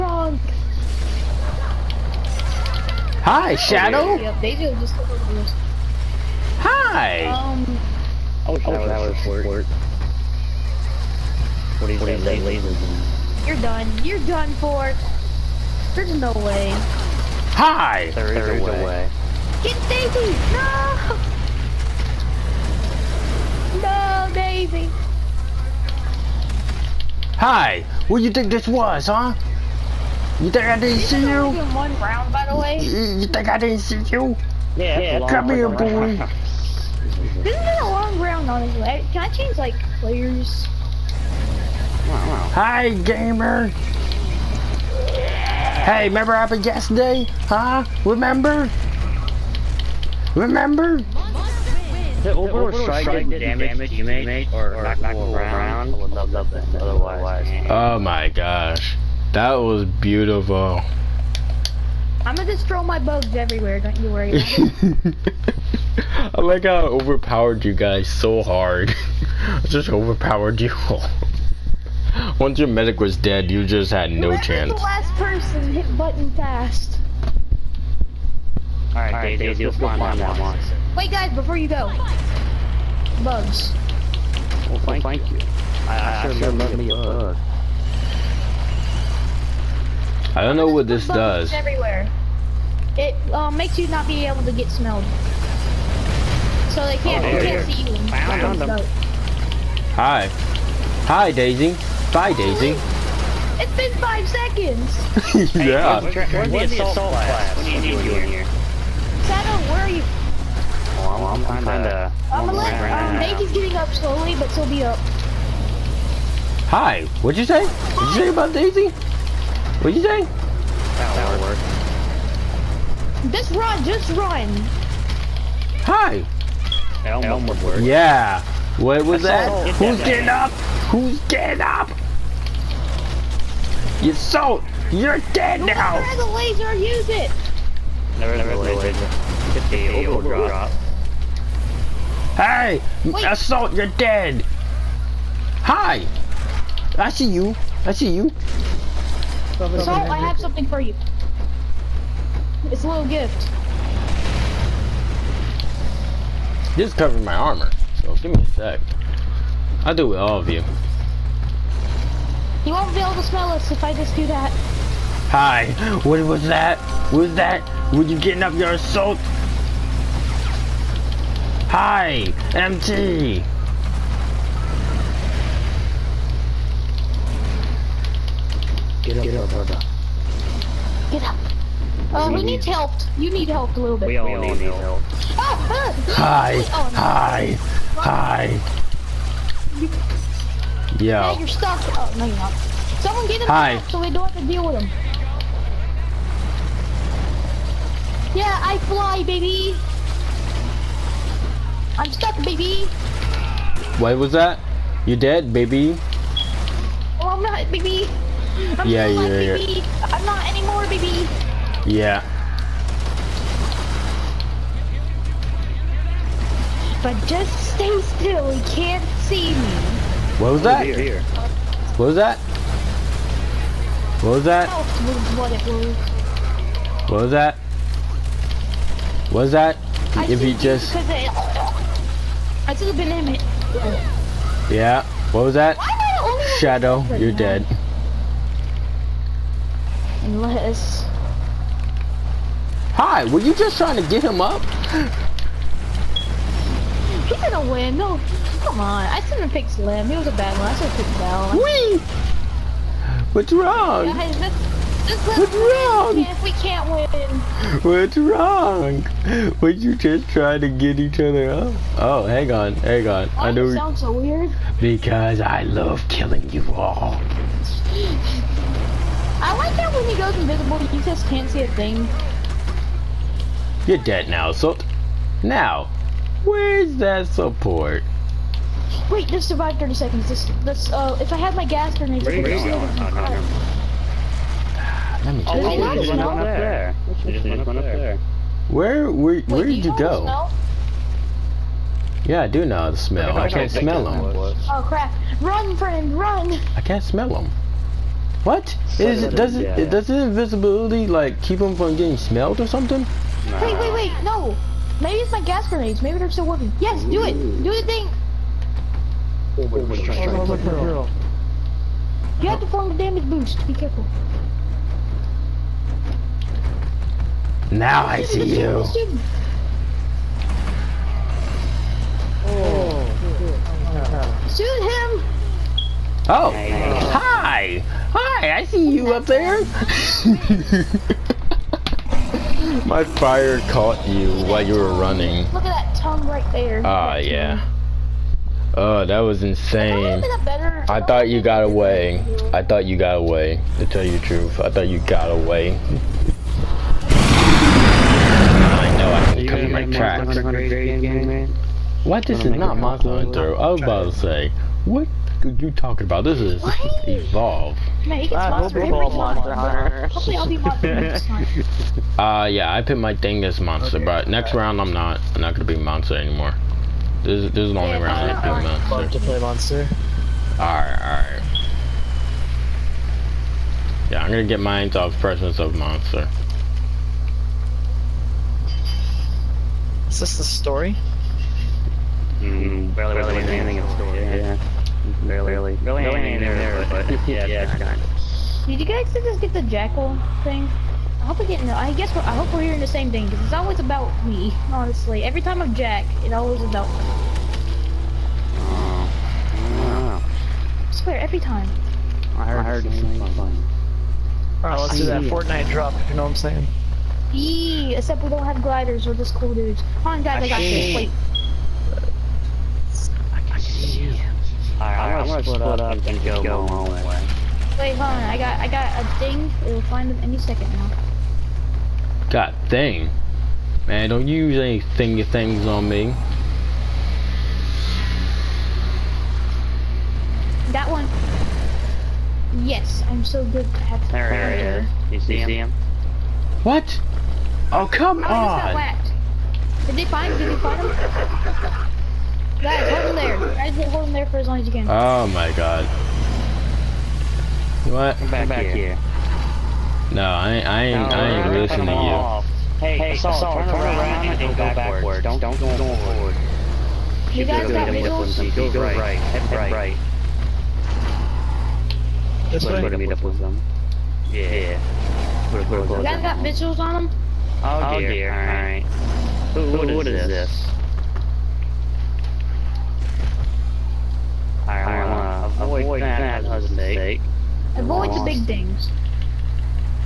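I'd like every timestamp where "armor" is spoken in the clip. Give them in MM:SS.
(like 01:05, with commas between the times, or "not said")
02:37.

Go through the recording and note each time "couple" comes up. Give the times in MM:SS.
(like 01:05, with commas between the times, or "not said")
not said.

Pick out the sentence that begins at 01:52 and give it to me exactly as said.
I'm gonna let, um, Bacon's getting up slowly, but still be up.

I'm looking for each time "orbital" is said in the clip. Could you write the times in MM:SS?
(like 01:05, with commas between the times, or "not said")
00:52.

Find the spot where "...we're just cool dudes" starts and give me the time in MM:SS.
06:49.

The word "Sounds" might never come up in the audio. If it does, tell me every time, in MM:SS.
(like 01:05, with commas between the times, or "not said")
04:23.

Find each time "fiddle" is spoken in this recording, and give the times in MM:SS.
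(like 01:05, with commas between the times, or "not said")
not said.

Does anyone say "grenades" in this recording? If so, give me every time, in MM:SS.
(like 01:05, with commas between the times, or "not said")
04:41, 05:05.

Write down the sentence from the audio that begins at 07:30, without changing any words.
No, I, ain't, I ain't, I ain't listening to you.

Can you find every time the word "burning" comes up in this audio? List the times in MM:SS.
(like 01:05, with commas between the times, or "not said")
not said.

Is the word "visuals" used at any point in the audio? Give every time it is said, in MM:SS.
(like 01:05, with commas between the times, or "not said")
07:37, 07:46.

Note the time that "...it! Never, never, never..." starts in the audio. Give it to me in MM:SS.
02:17.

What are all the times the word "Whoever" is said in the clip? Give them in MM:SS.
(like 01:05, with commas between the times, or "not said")
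01:14, 02:15.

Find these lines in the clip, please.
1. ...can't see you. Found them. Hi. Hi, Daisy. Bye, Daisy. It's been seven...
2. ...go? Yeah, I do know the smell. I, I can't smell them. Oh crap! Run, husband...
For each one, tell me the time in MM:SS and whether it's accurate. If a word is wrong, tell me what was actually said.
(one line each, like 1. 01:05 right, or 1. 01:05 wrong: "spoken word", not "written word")
1. 01:37 wrong: "five", not "seven"
2. 04:49 wrong: "friend", not "husband".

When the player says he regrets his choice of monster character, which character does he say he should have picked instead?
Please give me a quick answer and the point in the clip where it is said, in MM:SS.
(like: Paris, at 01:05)
Val, at 04:10.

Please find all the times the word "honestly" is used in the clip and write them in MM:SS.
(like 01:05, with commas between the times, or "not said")
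00:38, 06:34.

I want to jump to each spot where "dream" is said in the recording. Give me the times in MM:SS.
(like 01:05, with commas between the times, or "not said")
not said.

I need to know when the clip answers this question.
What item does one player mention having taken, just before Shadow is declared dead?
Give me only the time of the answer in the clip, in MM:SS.
03:52.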